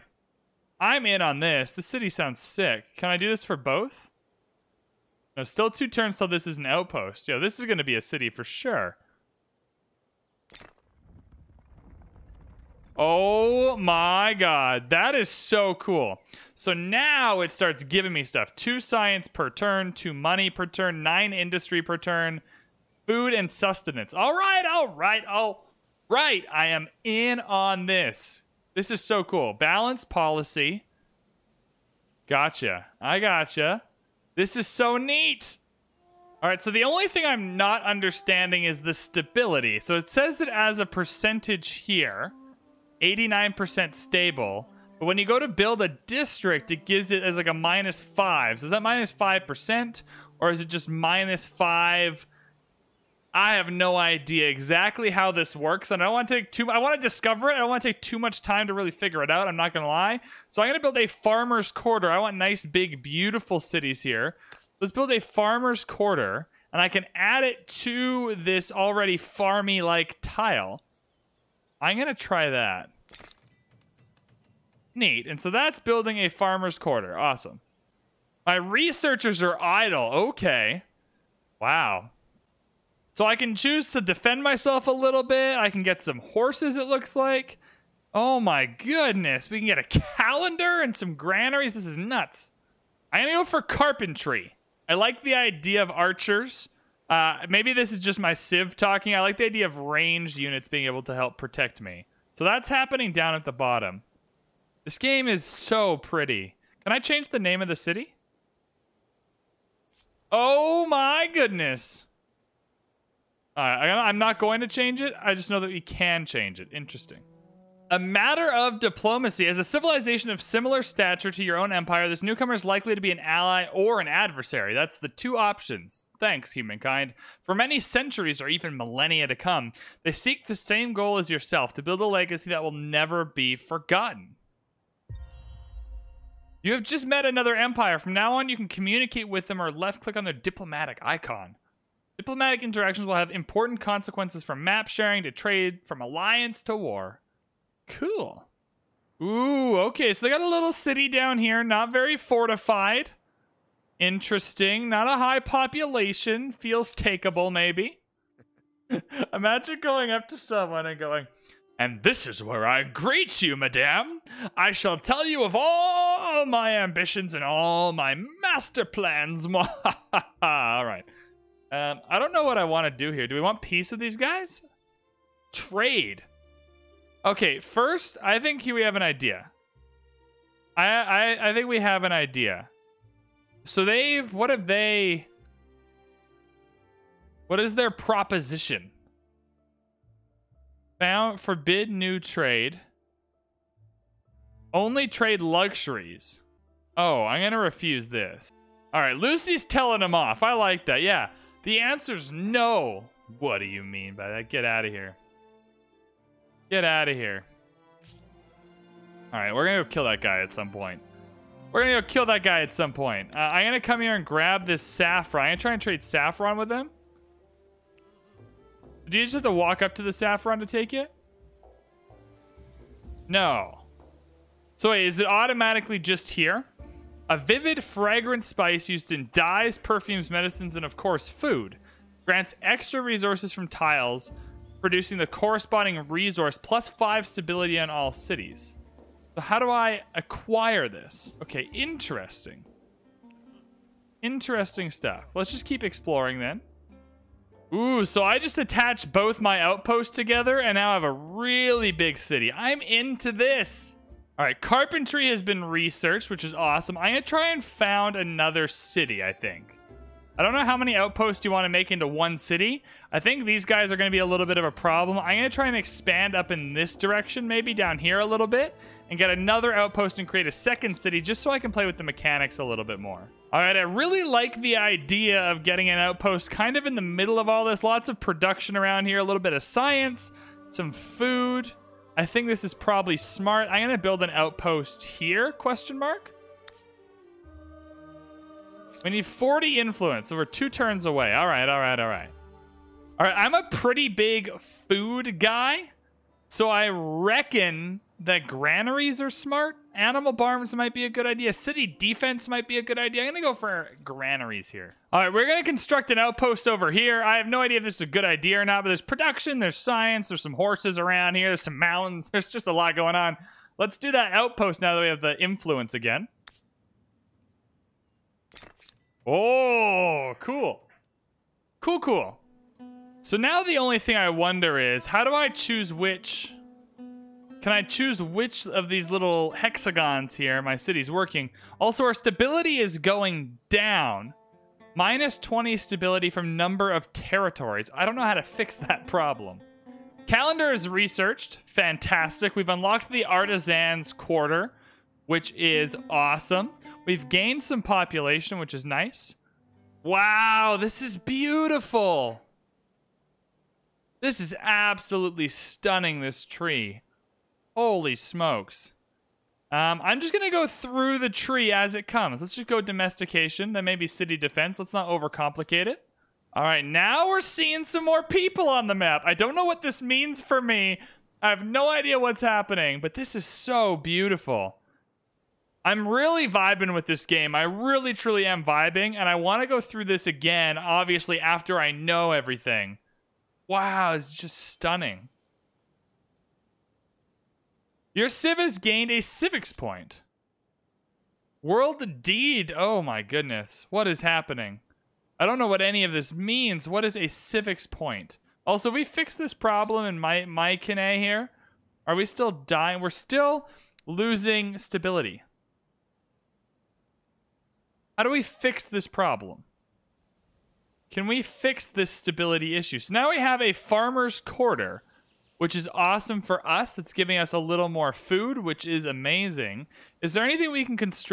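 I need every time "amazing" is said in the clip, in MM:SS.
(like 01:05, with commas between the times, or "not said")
06:59.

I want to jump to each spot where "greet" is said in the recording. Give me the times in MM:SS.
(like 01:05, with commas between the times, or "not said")
02:42.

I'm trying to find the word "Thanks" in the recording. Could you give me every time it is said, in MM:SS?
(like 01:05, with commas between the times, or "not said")
02:06.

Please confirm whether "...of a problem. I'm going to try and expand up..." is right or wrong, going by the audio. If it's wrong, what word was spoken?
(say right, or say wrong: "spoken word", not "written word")
right.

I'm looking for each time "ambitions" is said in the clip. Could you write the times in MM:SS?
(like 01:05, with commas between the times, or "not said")
02:46.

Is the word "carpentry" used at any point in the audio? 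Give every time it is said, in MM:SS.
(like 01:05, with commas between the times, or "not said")
01:33, 04:14.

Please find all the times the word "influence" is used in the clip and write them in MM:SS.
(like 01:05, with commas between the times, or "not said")
04:49, 05:15.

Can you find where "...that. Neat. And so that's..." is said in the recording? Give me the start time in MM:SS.
01:12.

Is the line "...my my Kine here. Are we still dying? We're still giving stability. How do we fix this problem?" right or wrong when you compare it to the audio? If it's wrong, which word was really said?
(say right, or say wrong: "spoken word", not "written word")
wrong: "losing", not "giving".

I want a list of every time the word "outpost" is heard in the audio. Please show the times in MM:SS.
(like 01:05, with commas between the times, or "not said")
00:06, 04:09, 04:20, 04:29, 04:35, 04:44, 05:06, 05:14.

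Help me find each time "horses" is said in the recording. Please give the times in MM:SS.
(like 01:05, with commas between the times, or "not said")
01:26, 05:10.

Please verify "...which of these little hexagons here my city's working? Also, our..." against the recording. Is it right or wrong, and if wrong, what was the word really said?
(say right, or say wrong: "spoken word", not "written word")
right.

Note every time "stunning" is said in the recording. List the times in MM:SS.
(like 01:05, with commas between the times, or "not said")
05:55, 06:24.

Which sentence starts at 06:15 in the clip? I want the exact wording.
I'm really vibing with this game.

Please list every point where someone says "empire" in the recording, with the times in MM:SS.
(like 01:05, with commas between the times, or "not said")
02:01, 02:17.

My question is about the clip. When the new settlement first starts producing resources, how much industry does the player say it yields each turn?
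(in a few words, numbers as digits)
9.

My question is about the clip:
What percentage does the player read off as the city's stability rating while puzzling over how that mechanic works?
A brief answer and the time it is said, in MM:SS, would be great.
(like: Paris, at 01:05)
89%, at 00:43.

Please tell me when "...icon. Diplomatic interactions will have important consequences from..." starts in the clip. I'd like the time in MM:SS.
02:21.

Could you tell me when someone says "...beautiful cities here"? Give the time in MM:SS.
01:03.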